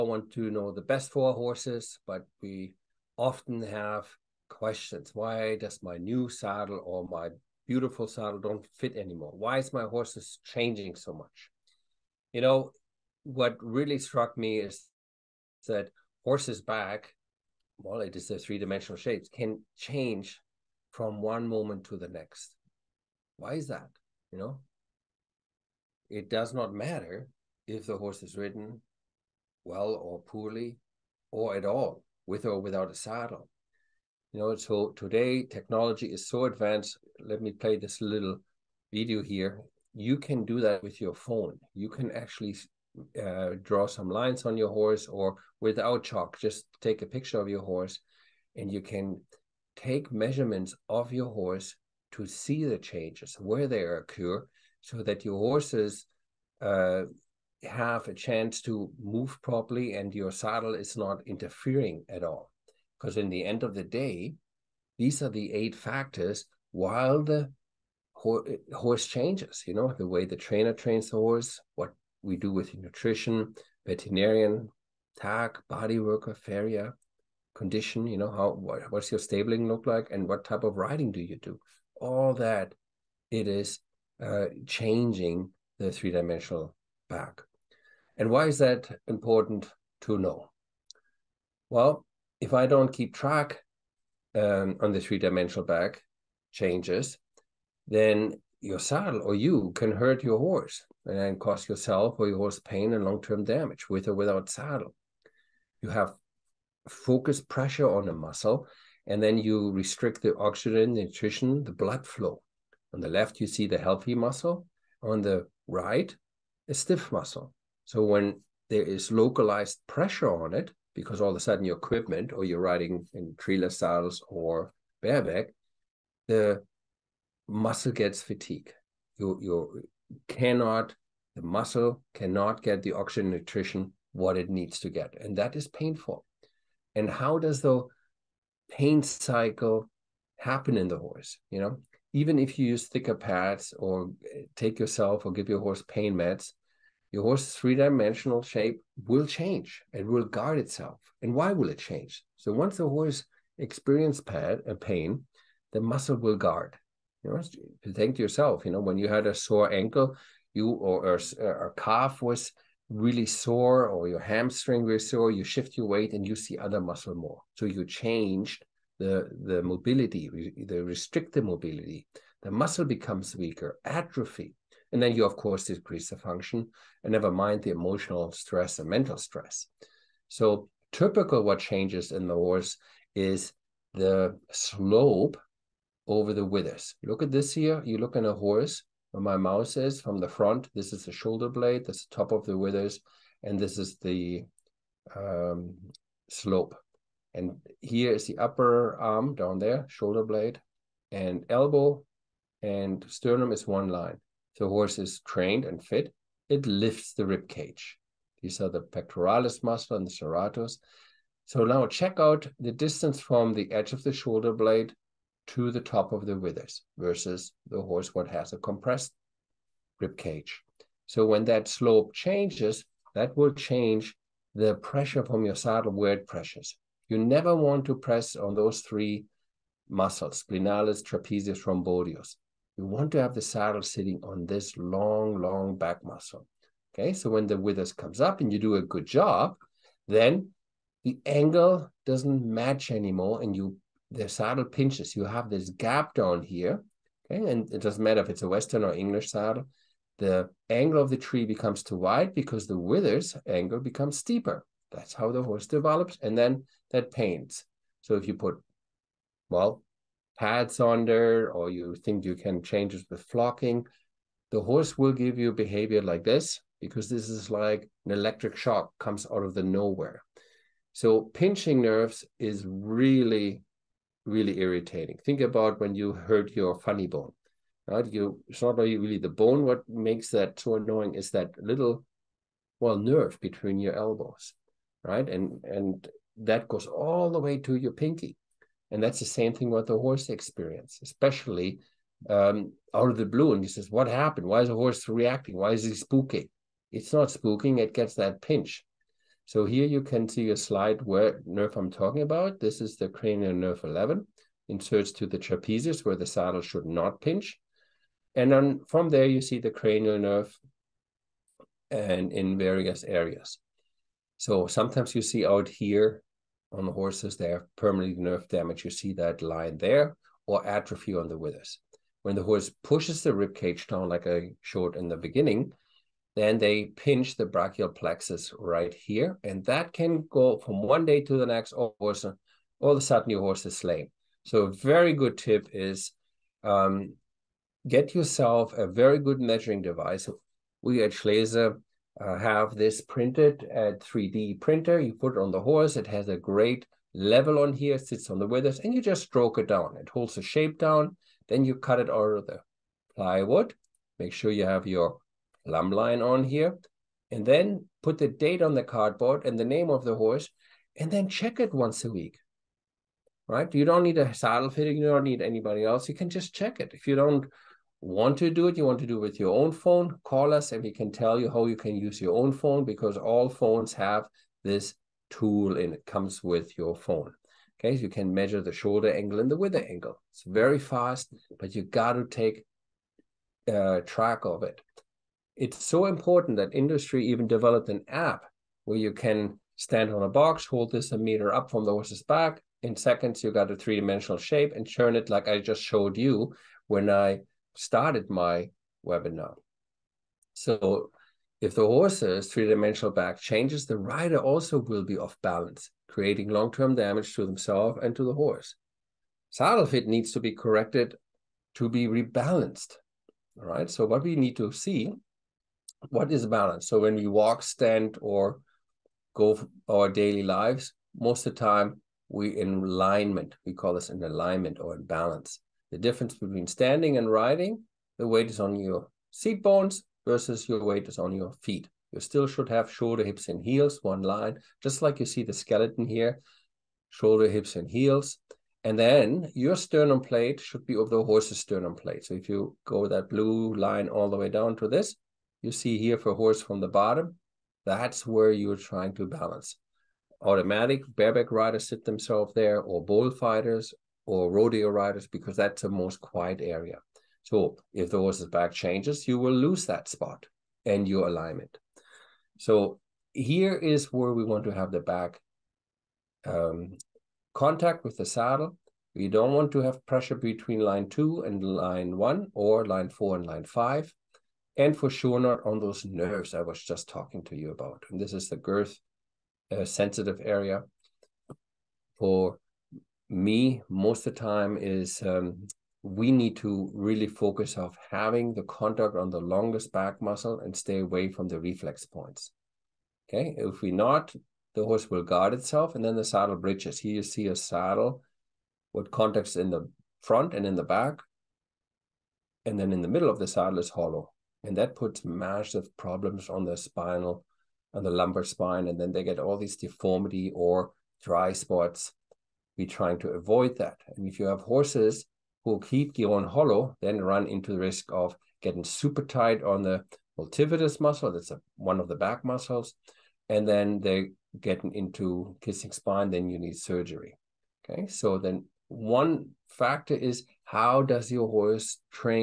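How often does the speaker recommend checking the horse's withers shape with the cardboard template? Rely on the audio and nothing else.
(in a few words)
Once a week.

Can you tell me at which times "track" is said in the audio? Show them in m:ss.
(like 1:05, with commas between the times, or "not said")
1:33, 6:24.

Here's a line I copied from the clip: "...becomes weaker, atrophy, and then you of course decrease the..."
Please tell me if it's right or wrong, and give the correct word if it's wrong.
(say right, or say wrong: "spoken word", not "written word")
right.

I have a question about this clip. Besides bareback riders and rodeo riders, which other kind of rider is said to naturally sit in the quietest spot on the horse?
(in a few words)
Bullfighters.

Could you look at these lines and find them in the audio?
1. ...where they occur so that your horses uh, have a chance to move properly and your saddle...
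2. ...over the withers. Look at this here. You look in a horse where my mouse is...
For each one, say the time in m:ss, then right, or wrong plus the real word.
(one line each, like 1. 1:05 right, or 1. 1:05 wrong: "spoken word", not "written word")
1. 0:53 right
2. 3:06 right.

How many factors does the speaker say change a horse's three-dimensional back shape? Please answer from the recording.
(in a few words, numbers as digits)
8.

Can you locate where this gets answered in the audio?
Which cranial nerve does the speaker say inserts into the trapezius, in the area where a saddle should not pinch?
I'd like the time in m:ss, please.
5:03.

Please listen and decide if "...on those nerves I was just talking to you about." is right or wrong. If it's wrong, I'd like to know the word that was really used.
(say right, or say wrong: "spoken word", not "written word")
right.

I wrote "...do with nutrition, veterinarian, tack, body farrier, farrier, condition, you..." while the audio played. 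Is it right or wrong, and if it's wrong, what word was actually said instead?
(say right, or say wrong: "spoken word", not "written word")
wrong: "worker", not "farrier".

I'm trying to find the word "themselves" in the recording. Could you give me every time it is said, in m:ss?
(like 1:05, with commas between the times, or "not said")
6:47, 7:32.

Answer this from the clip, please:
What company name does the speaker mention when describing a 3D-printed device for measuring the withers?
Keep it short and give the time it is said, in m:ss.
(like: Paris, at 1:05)
Schleese, at 5:41.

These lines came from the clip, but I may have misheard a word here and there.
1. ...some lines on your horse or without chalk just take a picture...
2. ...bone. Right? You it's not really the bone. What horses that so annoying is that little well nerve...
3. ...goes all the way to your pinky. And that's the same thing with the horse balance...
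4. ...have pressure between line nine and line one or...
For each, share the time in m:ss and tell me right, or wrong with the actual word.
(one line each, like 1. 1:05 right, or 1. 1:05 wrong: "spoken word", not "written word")
1. 0:43 right
2. 4:37 wrong: "makes", not "horses"
3. 4:46 wrong: "experience", not "balance"
4. 7:49 wrong: "two", not "nine".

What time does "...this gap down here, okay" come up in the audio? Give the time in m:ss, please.
4:05.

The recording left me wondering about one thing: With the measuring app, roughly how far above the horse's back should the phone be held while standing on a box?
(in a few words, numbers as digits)
A meter.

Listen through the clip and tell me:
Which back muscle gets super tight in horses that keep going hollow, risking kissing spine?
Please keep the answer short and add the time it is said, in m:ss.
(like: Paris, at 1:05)
Multifidus, at 8:40.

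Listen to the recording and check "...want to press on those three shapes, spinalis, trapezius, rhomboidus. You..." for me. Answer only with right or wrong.
wrong.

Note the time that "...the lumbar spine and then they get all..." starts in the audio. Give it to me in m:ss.
8:28.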